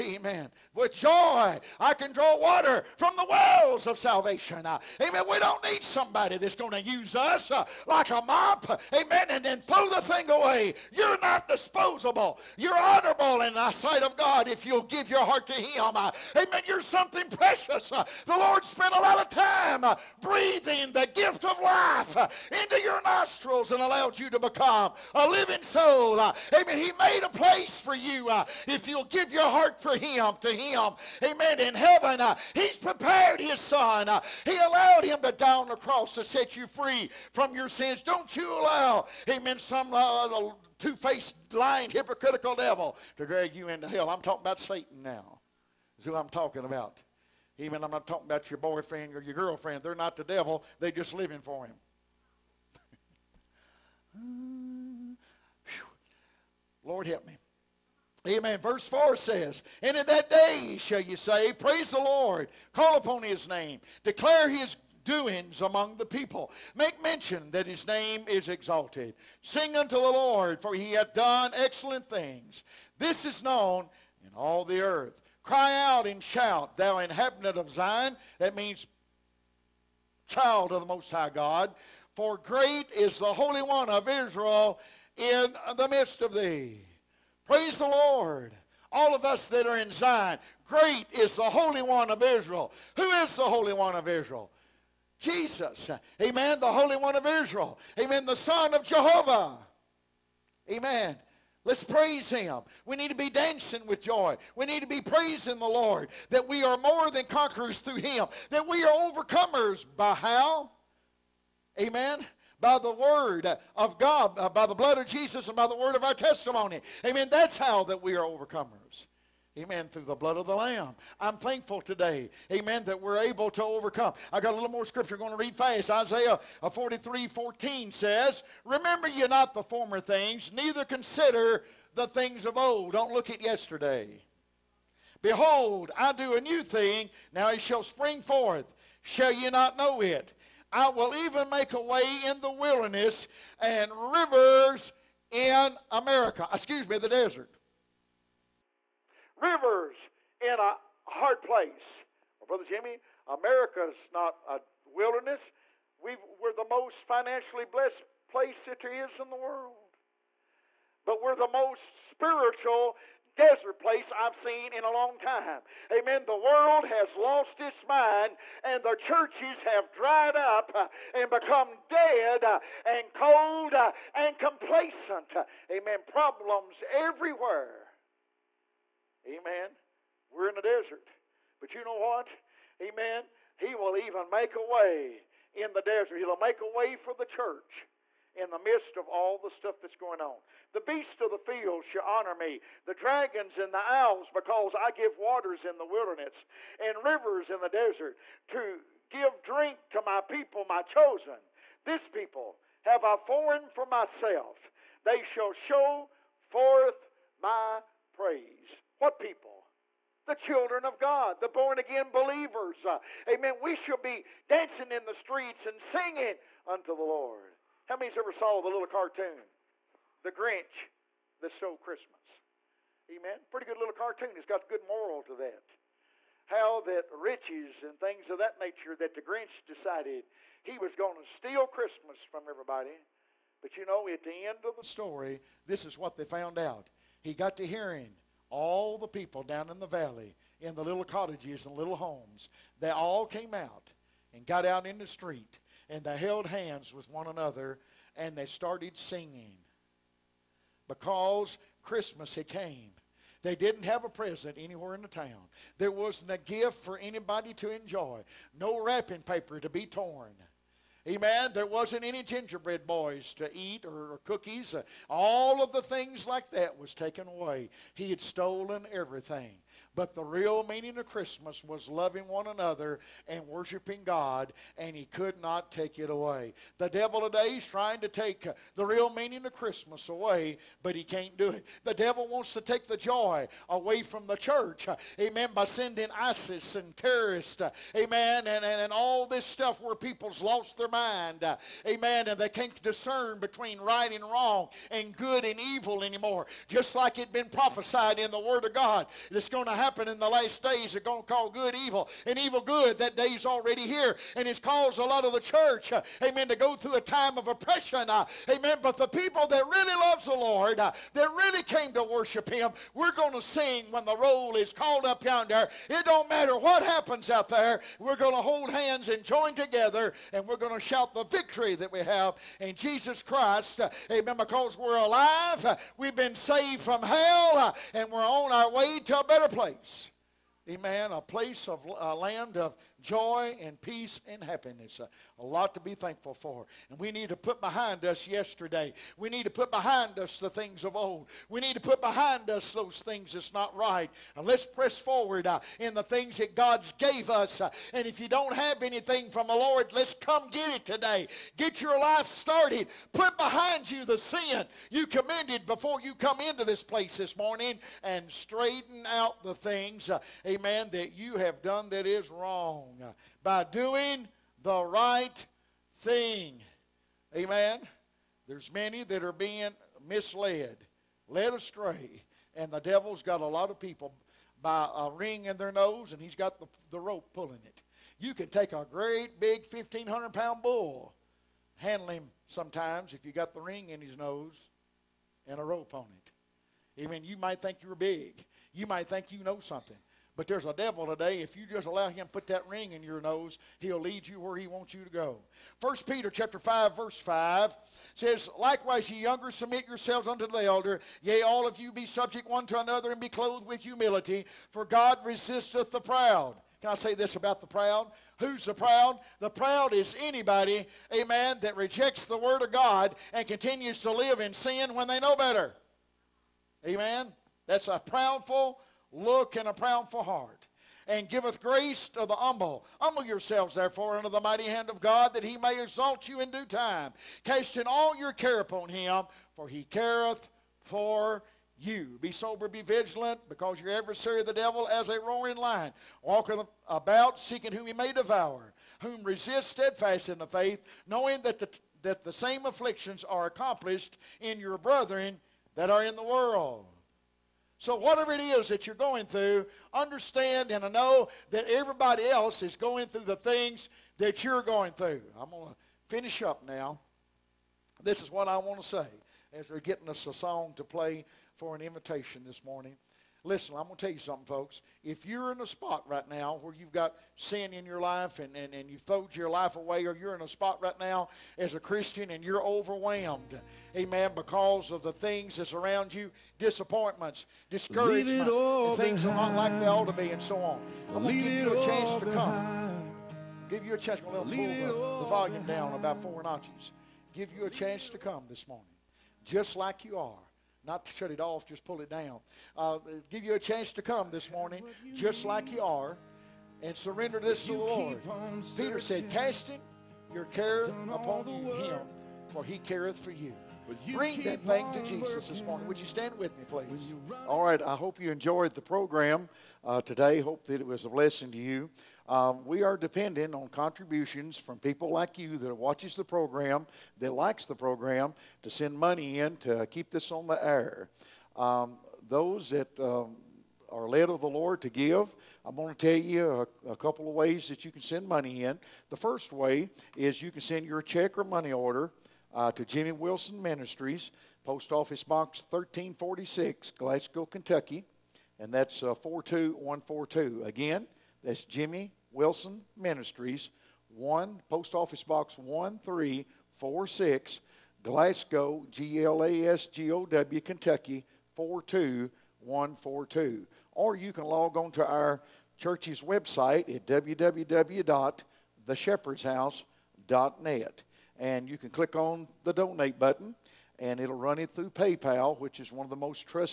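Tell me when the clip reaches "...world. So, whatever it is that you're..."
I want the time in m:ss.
7:26.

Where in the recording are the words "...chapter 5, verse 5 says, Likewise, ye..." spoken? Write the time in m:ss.
6:36.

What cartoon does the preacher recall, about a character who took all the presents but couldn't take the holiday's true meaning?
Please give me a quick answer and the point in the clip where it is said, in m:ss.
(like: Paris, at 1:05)
The Grinch That Stole Christmas, at 3:40.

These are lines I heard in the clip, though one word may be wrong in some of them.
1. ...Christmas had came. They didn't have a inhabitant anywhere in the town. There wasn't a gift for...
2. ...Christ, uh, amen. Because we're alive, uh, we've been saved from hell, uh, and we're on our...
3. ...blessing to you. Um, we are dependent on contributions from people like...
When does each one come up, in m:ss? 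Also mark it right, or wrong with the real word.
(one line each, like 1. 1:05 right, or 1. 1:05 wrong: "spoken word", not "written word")
1. 4:11 wrong: "present", not "inhabitant"
2. 5:23 right
3. 8:31 right.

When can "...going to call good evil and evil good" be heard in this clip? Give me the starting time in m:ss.
5:01.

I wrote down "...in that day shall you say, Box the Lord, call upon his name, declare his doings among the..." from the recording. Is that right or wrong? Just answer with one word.
wrong.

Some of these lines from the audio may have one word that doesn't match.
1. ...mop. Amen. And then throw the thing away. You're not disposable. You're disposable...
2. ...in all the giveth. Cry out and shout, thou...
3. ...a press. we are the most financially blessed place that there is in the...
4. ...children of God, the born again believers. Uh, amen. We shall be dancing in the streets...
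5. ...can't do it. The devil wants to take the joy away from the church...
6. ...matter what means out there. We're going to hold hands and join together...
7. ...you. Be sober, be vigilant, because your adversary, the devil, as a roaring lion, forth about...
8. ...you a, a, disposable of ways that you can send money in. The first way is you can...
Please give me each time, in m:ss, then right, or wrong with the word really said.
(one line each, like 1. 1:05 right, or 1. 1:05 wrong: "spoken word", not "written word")
1. 0:08 wrong: "honorable", not "disposable"
2. 1:14 wrong: "earth", not "giveth"
3. 2:34 wrong: "wilderness", not "press"
4. 3:30 right
5. 4:41 right
6. 5:16 wrong: "happens", not "means"
7. 7:11 wrong: "walketh", not "forth"
8. 8:46 wrong: "couple", not "disposable".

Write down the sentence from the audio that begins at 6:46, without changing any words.
Can I say this about the proud?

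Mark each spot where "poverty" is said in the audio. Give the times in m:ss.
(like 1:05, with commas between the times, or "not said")
not said.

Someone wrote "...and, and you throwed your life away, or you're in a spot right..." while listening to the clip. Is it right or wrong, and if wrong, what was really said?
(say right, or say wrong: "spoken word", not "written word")
right.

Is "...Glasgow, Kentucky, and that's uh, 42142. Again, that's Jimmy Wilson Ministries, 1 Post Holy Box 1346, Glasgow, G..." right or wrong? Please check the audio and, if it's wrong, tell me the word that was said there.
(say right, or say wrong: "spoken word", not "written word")
wrong: "Office", not "Holy".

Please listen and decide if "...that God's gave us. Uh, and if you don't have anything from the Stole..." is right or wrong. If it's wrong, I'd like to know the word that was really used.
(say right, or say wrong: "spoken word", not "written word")
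wrong: "Lord", not "Stole".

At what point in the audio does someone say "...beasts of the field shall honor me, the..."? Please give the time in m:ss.
3:10.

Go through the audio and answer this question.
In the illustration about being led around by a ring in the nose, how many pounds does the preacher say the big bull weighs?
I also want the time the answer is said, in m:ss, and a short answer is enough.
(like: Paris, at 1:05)
1,500, at 6:19.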